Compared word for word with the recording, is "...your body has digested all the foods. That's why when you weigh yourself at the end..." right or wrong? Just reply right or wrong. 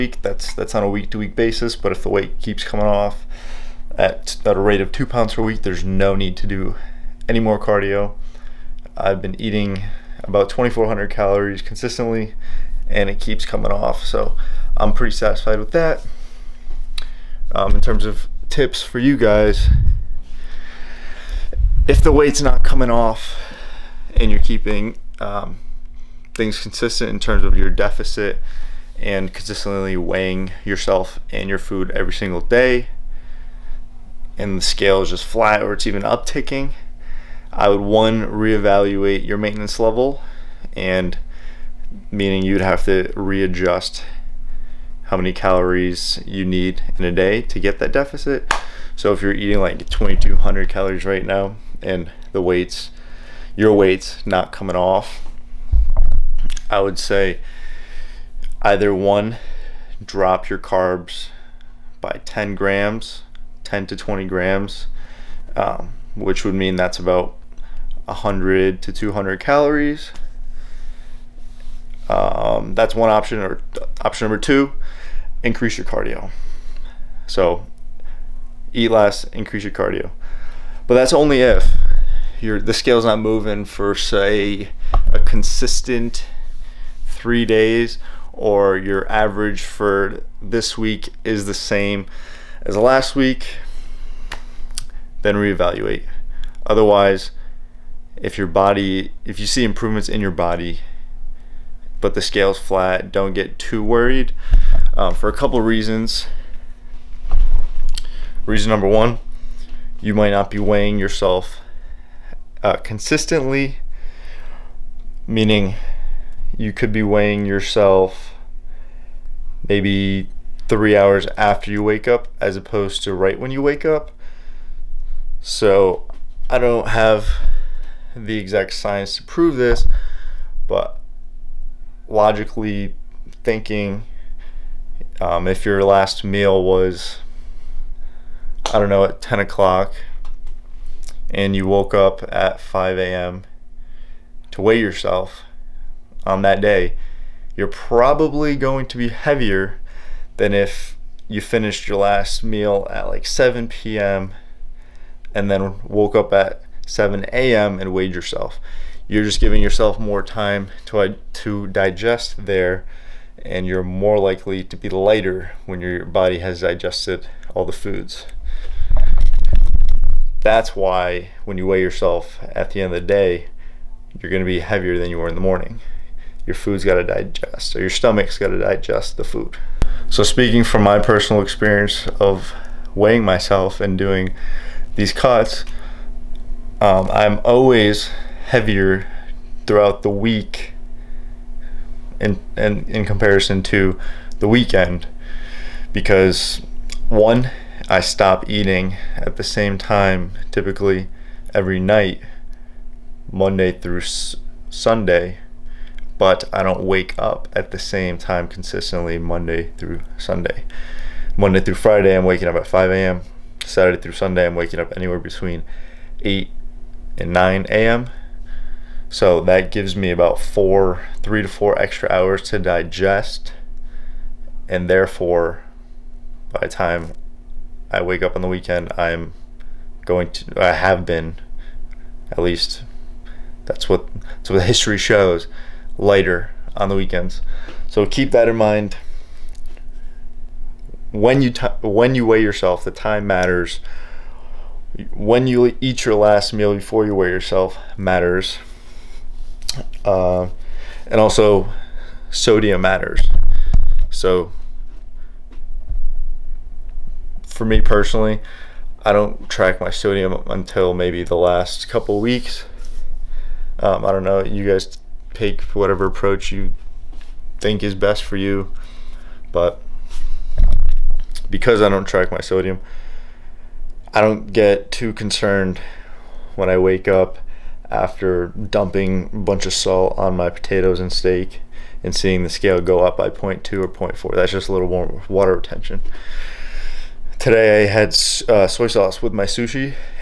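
right.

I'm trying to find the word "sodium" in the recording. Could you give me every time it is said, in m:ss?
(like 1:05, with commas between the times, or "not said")
4:12, 4:19, 4:32.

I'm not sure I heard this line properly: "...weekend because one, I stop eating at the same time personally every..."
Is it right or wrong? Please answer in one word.
wrong.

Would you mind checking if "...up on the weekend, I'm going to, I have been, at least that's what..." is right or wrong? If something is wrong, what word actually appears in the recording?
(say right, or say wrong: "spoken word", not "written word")
right.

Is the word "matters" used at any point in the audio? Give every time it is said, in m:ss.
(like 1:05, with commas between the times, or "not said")
4:03, 4:07, 4:12.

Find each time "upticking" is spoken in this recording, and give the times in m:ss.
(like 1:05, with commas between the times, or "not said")
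0:36.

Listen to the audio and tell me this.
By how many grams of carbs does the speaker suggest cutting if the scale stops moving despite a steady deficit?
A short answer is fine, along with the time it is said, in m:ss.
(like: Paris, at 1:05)
10 to 20 grams, at 1:03.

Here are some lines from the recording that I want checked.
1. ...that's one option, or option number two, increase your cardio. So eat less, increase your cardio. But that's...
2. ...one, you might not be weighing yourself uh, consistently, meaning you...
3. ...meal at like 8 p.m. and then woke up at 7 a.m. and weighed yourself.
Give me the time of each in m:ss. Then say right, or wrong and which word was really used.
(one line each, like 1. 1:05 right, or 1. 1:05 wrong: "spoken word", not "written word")
1. 1:12 right
2. 1:48 right
3. 2:32 wrong: "7", not "8".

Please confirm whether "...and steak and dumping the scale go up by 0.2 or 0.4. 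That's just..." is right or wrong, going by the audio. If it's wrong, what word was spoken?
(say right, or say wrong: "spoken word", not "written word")
wrong: "seeing", not "dumping".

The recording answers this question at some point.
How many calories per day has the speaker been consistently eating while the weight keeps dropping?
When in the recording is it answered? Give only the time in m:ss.
0:10.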